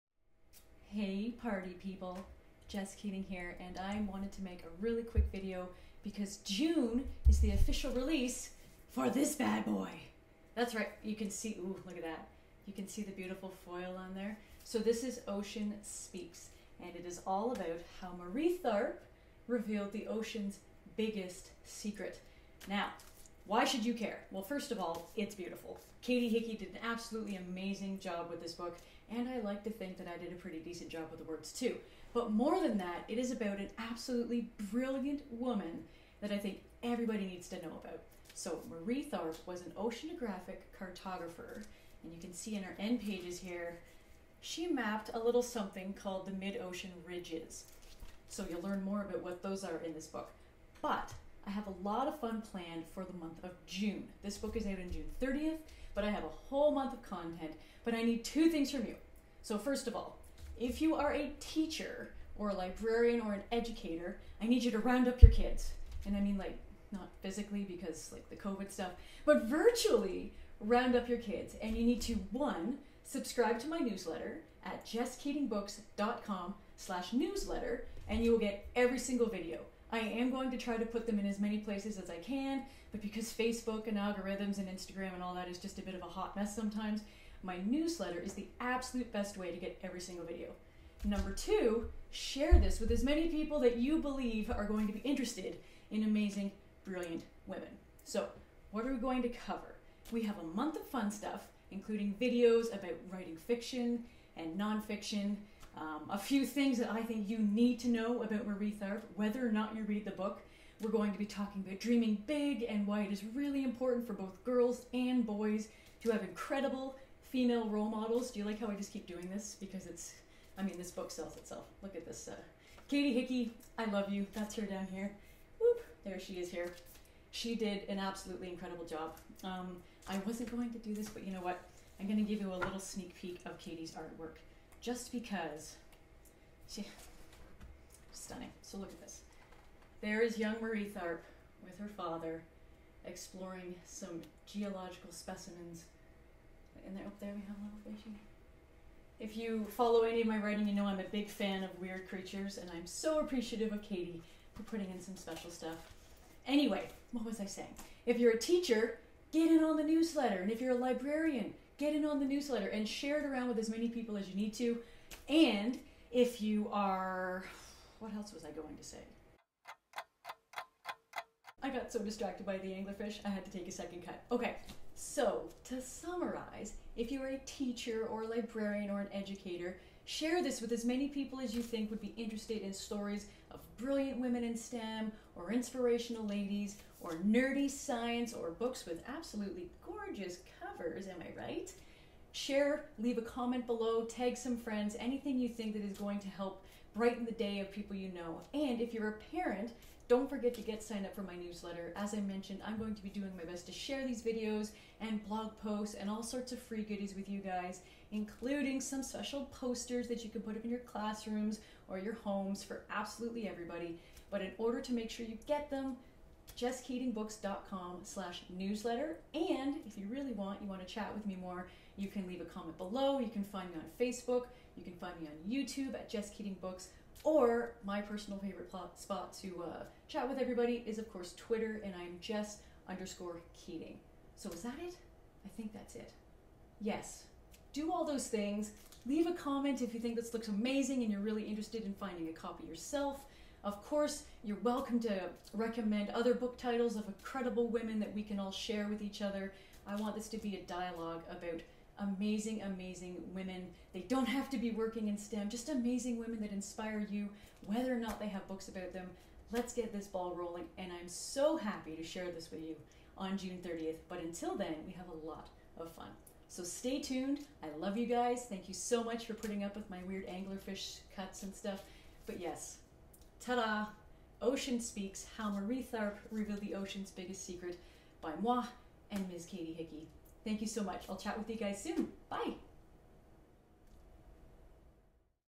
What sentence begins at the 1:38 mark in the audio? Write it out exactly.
So, what are we going to cover?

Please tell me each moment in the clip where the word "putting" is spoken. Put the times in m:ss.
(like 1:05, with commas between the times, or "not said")
2:34, 4:29.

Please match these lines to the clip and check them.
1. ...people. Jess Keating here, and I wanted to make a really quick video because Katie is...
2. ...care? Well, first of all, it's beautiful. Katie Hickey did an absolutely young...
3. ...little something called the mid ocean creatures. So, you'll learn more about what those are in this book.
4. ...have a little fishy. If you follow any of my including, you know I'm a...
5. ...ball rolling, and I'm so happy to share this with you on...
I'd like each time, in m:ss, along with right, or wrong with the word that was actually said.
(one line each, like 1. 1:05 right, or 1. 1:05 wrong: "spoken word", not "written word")
1. 0:01 wrong: "June", not "Katie"
2. 0:23 wrong: "amazing", not "young"
3. 0:45 wrong: "ridges", not "creatures"
4. 2:27 wrong: "writing", not "including"
5. 4:20 right.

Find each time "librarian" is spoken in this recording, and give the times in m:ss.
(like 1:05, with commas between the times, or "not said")
1:02, 2:40, 2:58.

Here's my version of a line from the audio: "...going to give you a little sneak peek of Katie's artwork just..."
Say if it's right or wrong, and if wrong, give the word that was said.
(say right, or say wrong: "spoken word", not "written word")
right.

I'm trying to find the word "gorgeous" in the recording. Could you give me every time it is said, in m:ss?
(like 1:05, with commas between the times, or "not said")
3:09.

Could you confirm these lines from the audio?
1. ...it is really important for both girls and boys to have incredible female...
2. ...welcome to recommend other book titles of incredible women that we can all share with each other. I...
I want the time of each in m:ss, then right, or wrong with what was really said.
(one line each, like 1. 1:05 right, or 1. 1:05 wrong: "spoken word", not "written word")
1. 1:53 right
2. 4:04 right.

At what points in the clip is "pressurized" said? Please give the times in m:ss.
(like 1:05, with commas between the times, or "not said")
not said.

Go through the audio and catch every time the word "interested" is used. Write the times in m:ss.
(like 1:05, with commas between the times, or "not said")
1:34, 3:02, 4:01.